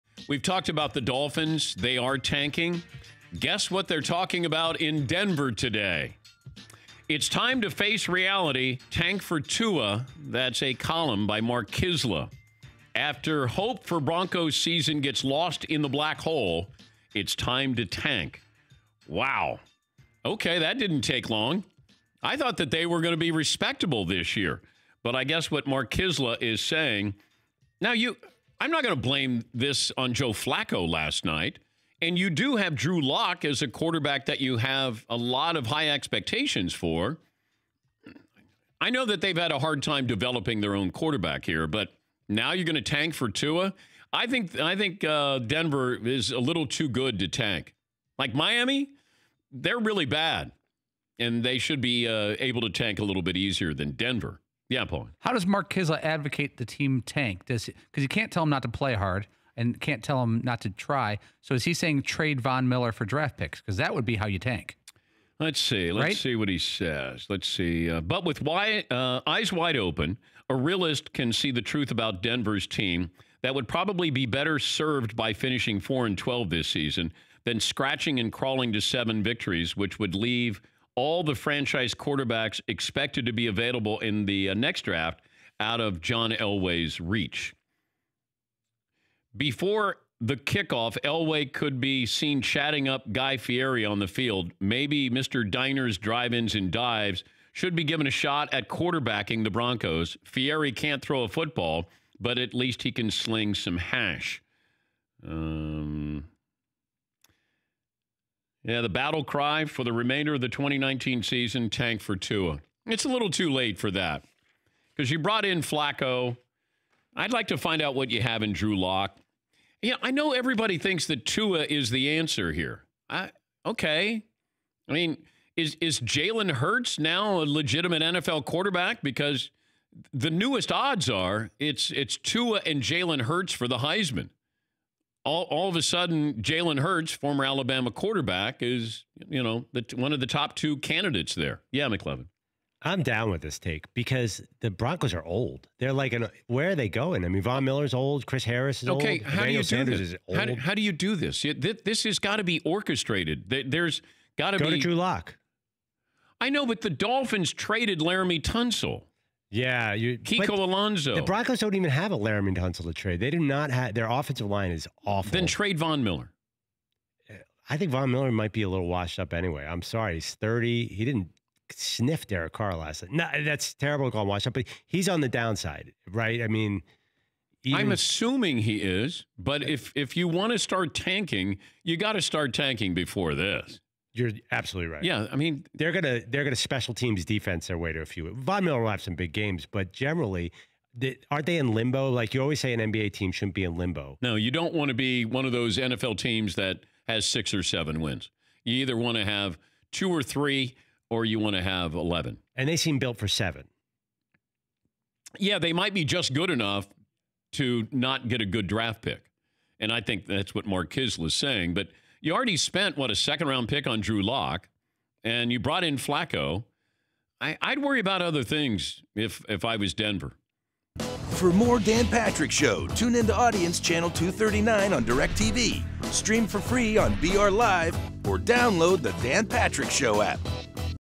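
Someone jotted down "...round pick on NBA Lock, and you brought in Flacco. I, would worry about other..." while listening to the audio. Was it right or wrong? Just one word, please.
wrong.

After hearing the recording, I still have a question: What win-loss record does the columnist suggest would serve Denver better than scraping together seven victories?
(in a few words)
4 and 12.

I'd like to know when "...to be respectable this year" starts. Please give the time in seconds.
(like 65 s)
23 s.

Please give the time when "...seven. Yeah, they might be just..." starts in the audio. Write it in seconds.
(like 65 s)
203 s.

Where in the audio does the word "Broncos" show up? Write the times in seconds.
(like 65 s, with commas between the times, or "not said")
13 s, 99 s, 144 s, 161 s.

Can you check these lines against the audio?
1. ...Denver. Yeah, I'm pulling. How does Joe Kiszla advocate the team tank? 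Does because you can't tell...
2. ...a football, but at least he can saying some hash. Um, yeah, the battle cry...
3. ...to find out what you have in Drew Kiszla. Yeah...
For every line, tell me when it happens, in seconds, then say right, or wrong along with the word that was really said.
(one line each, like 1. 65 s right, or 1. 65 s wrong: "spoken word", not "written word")
1. 53 s wrong: "Mark", not "Joe"
2. 101 s wrong: "sling", not "saying"
3. 117 s wrong: "Lock", not "Kiszla".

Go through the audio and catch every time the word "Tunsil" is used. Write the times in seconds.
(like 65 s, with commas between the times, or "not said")
158 s, 162 s.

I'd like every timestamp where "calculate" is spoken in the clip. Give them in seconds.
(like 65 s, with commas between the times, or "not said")
not said.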